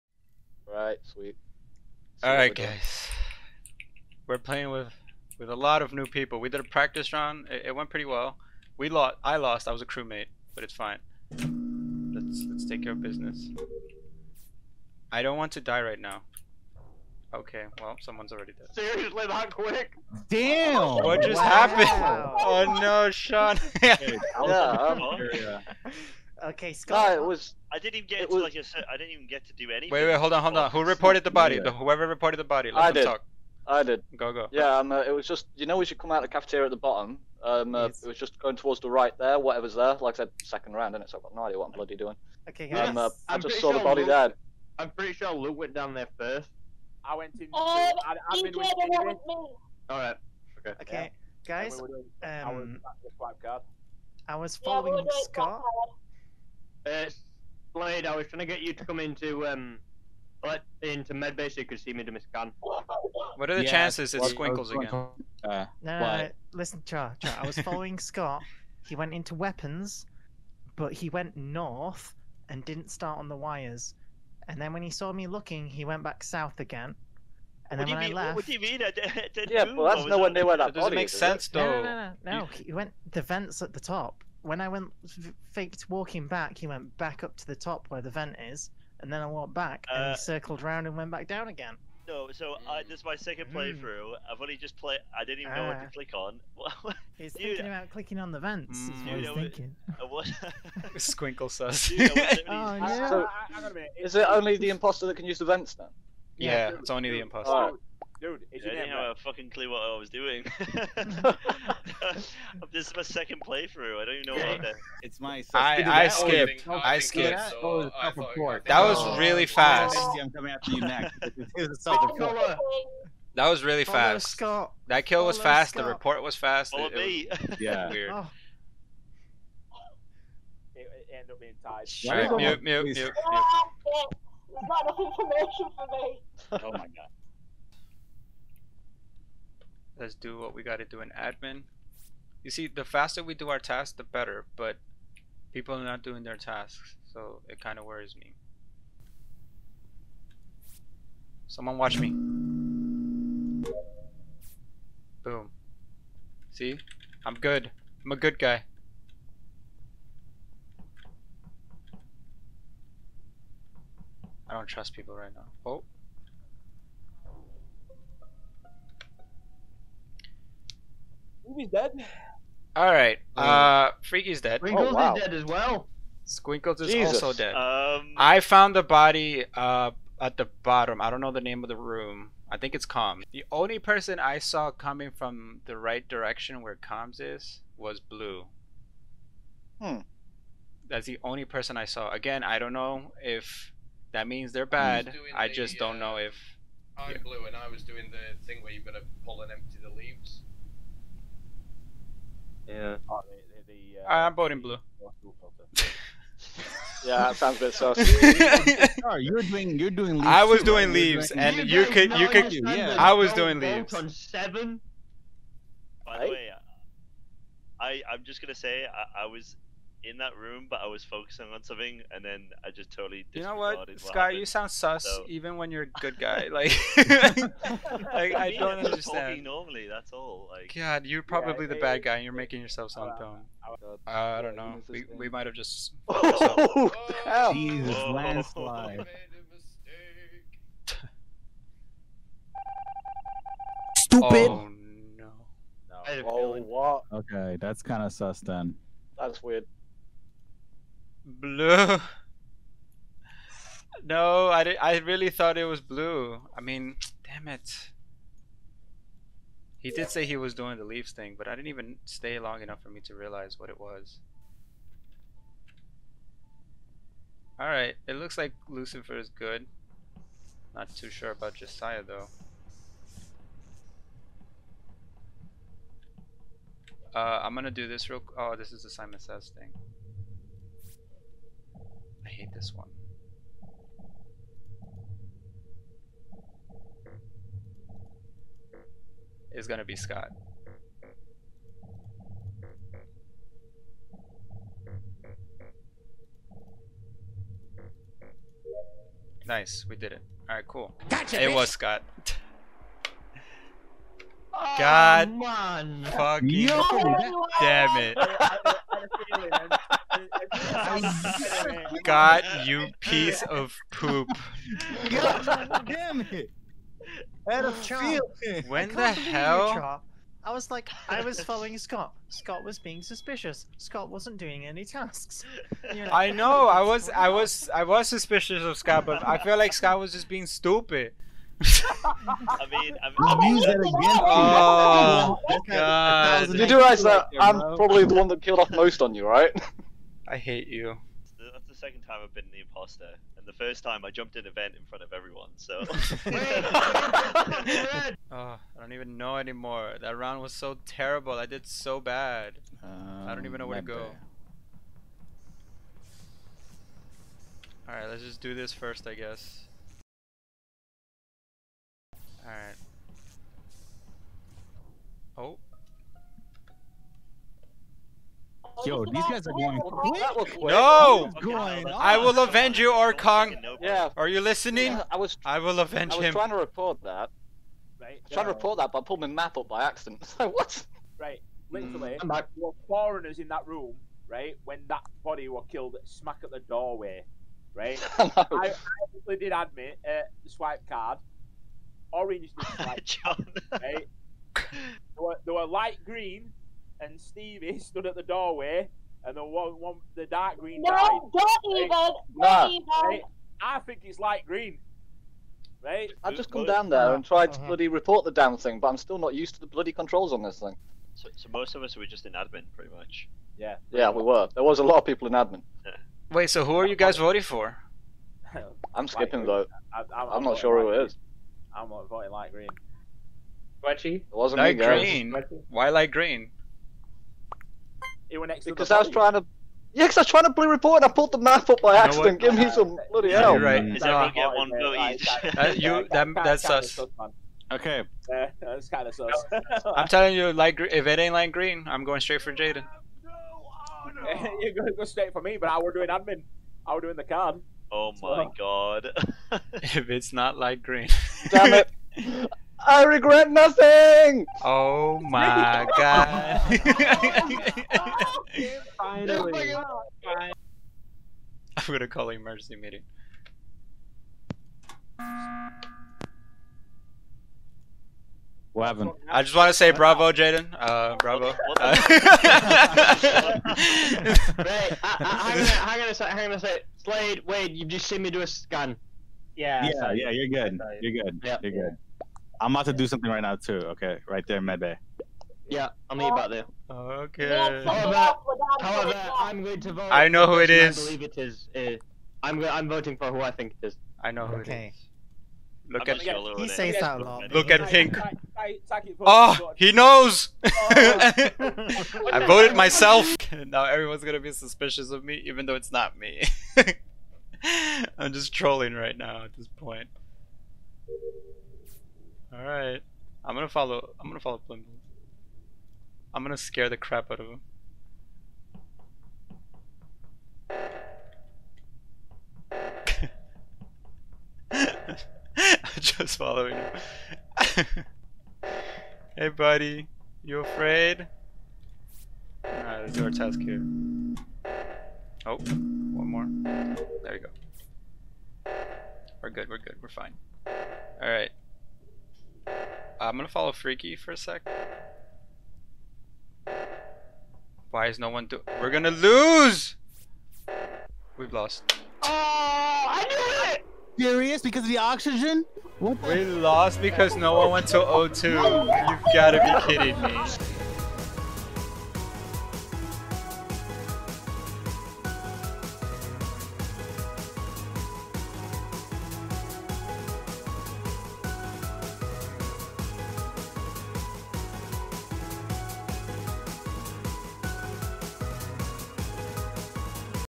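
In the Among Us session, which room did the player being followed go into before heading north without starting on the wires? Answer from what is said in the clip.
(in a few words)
Weapons.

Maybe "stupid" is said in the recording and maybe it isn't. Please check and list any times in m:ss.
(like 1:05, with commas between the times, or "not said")
4:03, 5:30.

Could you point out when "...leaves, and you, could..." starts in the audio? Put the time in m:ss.
3:30.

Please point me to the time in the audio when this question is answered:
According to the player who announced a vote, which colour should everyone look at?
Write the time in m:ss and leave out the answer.
8:17.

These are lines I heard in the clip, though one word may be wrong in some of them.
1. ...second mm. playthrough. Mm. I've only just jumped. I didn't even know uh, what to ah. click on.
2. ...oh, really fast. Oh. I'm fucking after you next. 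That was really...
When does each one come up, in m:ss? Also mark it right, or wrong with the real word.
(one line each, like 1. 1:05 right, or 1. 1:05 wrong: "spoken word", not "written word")
1. 1:33 wrong: "played", not "jumped"
2. 1:58 wrong: "coming", not "fucking".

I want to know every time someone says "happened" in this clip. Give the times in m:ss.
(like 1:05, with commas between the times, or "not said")
0:21, 3:44, 7:48.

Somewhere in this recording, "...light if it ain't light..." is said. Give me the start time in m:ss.
7:20.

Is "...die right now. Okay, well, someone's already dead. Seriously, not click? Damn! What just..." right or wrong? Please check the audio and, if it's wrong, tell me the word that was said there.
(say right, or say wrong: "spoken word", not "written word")
wrong: "quick", not "click".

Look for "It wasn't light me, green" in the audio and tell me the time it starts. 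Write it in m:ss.
7:04.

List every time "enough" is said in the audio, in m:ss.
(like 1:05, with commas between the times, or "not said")
2:14, 4:22.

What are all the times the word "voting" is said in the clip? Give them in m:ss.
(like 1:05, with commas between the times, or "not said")
3:24, 6:57, 7:01, 8:12.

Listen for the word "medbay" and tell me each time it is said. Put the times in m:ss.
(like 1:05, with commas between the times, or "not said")
1:01, 8:04.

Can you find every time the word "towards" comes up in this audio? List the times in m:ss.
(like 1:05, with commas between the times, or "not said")
0:38.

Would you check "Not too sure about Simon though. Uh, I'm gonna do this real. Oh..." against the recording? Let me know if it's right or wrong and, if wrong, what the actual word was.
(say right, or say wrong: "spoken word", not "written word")
wrong: "Josiah", not "Simon".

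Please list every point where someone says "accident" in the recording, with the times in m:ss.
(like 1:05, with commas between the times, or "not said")
6:19, 7:11.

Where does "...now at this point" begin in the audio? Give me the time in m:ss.
8:29.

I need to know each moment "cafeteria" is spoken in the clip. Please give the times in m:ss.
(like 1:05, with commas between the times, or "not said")
0:36.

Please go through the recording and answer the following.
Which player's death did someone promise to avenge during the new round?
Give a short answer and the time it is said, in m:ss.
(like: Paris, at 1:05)
Orkong, at 6:11.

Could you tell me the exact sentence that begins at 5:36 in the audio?
You do realize that I'm probably the one that killed off most on you, right?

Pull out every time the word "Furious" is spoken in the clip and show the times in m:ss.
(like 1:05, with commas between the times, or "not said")
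9:14.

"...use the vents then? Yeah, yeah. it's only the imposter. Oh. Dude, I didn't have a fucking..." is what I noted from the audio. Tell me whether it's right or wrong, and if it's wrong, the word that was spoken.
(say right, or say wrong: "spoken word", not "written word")
right.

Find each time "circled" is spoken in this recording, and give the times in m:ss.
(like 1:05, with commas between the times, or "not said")
1:30.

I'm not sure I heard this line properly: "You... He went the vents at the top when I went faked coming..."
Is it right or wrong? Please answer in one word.
wrong.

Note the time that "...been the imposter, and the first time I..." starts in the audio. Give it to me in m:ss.
5:42.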